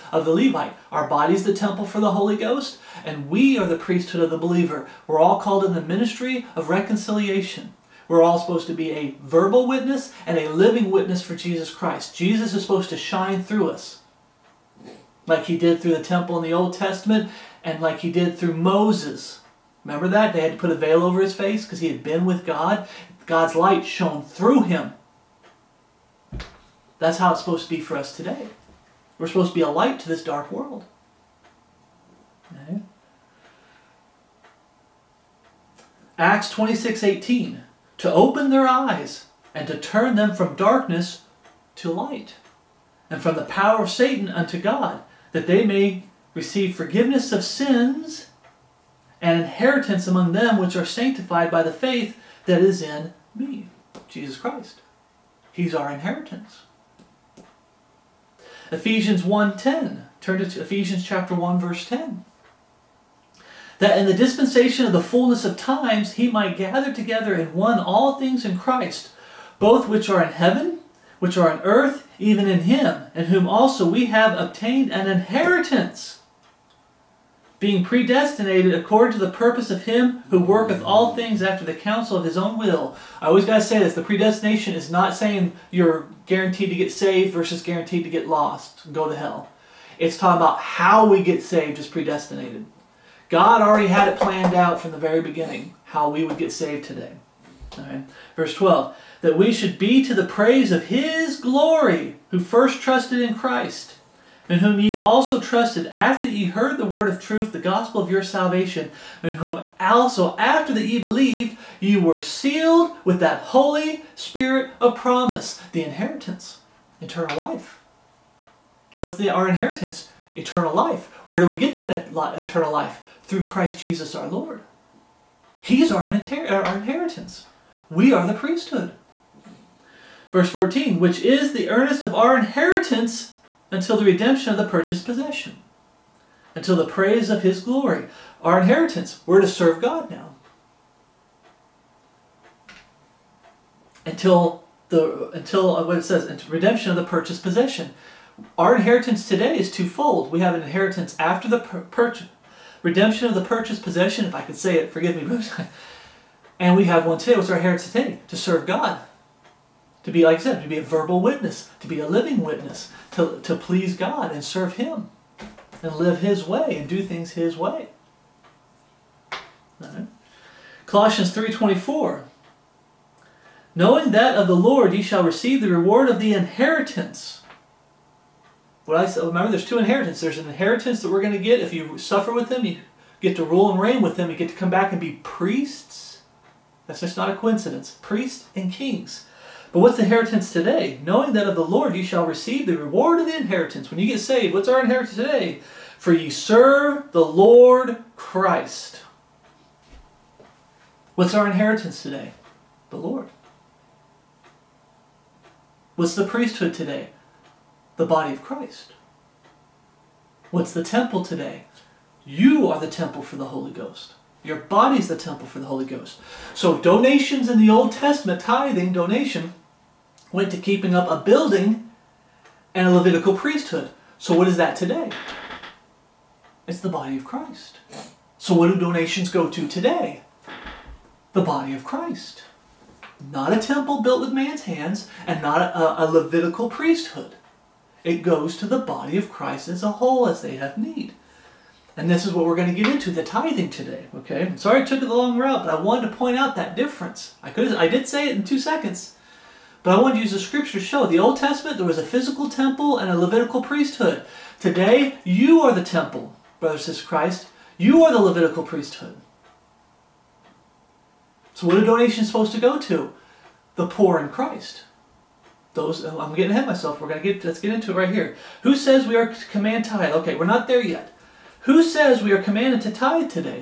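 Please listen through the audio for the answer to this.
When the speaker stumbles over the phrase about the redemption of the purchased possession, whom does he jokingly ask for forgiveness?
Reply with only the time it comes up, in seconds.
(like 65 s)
155 s.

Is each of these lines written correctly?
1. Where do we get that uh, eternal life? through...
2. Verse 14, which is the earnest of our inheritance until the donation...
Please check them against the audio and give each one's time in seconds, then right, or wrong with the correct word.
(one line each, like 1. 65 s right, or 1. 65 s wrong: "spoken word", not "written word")
1. 121 s right
2. 130 s wrong: "redemption", not "donation".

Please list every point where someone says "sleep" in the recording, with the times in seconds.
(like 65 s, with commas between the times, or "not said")
not said.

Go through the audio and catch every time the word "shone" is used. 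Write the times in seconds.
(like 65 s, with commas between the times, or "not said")
23 s.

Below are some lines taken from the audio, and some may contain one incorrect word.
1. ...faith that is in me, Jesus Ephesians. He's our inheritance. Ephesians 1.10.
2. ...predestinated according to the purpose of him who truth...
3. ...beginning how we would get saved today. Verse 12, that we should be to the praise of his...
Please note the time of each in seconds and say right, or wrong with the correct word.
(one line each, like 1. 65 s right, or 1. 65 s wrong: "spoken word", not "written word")
1. 51 s wrong: "Christ", not "Ephesians"
2. 77 s wrong: "worketh", not "truth"
3. 95 s right.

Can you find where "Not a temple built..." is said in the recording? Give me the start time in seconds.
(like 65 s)
233 s.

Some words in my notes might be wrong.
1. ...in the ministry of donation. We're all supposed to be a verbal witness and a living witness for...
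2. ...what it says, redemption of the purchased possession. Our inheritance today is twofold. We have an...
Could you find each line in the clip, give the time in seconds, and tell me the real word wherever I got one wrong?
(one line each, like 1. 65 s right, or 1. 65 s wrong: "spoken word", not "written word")
1. 5 s wrong: "reconciliation", not "donation"
2. 145 s right.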